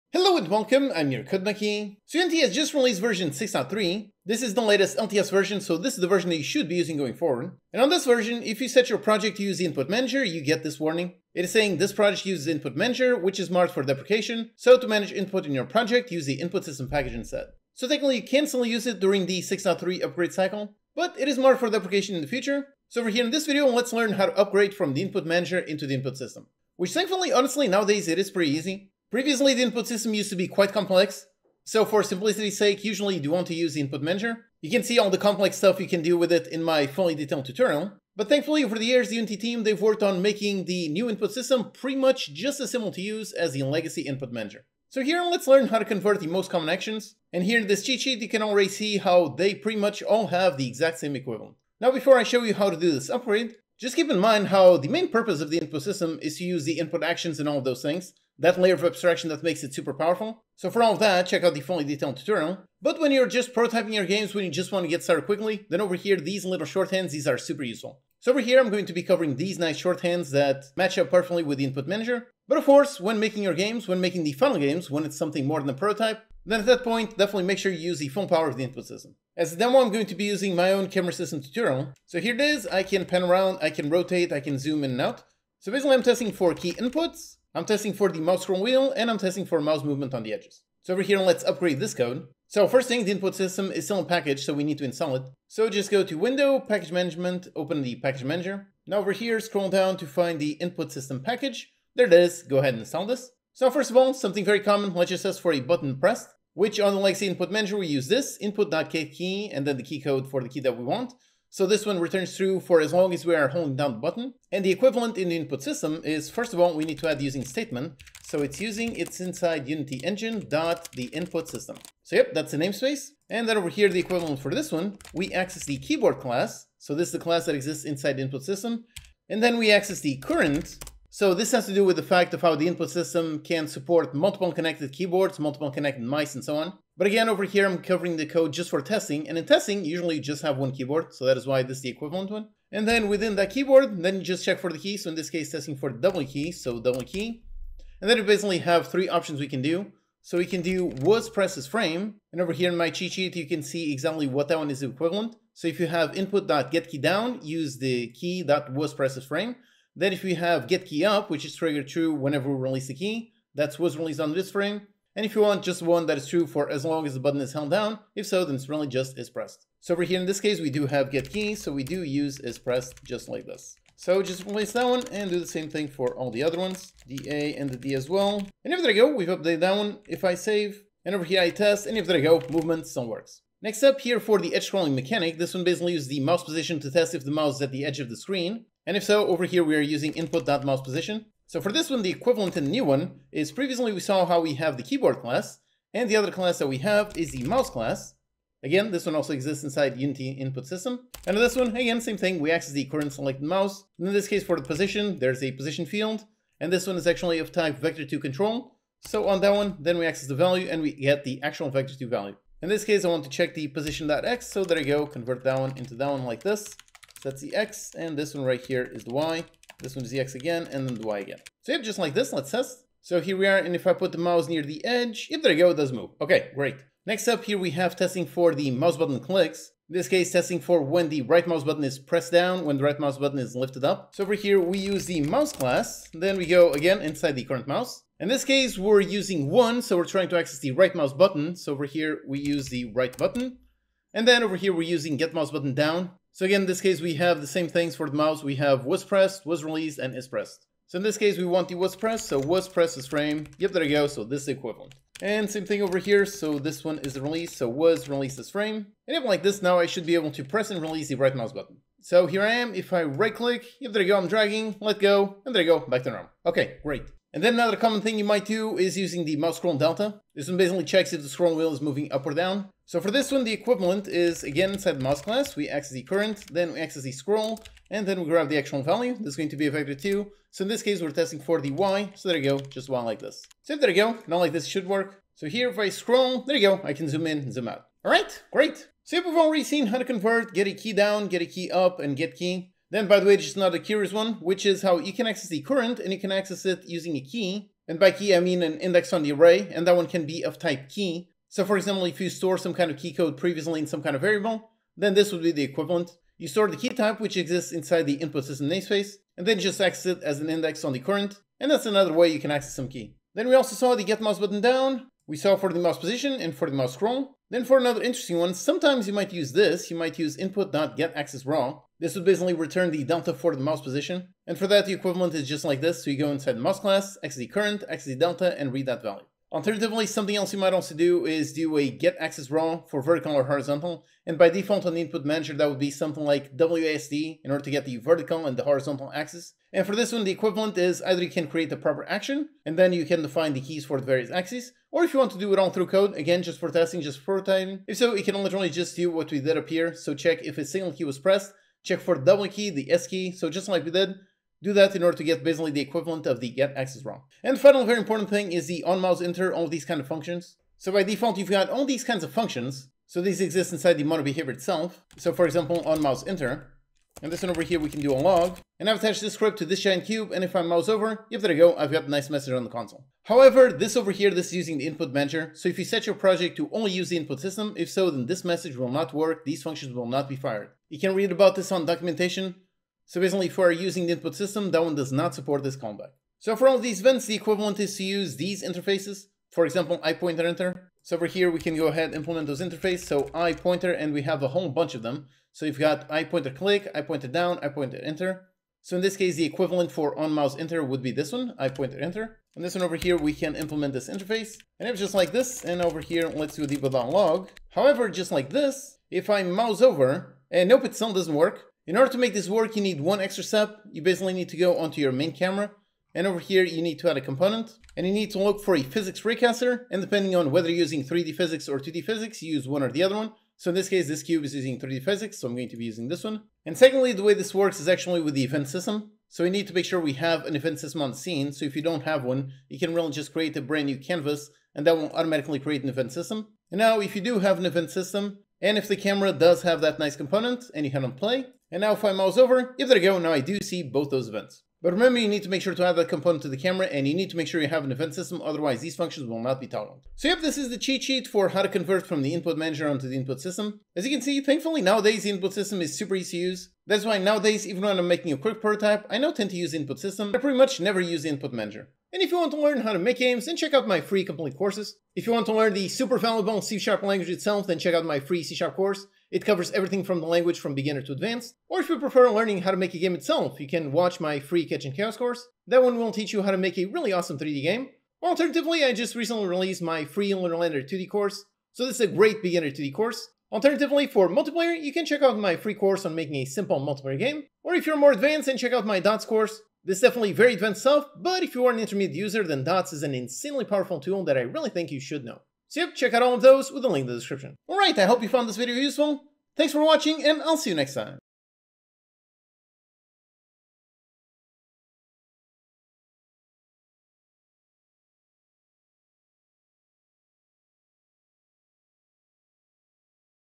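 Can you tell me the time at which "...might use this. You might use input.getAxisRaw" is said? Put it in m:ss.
5:19.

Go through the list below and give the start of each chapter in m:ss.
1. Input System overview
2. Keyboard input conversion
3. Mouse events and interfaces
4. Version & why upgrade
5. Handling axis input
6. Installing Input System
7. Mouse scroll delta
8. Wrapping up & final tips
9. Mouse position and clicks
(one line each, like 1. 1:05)
1. 1:12
2. 3:03
3. 6:00
4. 0:23
5. 5:17
6. 2:32
7. 4:30
8. 7:30
9. 3:46.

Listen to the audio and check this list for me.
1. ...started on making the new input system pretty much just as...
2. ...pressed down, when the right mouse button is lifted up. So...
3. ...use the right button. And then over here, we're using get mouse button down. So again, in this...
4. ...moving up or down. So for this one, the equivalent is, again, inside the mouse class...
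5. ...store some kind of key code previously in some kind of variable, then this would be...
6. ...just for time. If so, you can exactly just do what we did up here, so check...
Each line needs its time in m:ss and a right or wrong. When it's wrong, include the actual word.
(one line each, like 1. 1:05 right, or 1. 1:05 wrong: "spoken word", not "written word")
1. 0:39 wrong: "worked", not "started"
2. 3:51 right
3. 4:02 right
4. 4:31 right
5. 5:02 right
6. 5:47 wrong: "literally", not "exactly".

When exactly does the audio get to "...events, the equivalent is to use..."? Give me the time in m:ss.
6:27.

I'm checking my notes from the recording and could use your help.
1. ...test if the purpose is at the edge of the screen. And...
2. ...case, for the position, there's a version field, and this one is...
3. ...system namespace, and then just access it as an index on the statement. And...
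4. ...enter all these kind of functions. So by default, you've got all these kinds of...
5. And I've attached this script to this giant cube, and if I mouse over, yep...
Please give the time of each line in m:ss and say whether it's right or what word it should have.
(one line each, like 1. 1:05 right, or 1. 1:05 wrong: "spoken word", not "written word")
1. 3:06 wrong: "mouse", not "purpose"
2. 3:24 wrong: "position", not "version"
3. 5:08 wrong: "current", not "statement"
4. 5:59 right
5. 6:08 right.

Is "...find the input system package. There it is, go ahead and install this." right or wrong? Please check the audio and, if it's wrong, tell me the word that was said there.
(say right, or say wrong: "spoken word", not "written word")
right.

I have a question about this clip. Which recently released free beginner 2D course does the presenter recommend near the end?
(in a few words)
Lunar Lander.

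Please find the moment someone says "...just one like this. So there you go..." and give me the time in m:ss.
4:42.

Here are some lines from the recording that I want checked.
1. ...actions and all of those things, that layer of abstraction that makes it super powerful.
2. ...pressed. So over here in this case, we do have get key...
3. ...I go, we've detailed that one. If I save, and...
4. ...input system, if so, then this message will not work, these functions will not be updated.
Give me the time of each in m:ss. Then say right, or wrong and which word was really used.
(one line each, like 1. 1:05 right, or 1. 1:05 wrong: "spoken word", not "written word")
1. 0:57 right
2. 2:49 right
3. 2:58 wrong: "updated", not "detailed"
4. 6:17 wrong: "fired", not "updated".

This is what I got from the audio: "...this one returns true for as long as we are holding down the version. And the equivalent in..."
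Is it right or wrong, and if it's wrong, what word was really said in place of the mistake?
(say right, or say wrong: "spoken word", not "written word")
wrong: "button", not "version".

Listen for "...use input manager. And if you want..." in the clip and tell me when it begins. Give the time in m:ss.
7:40.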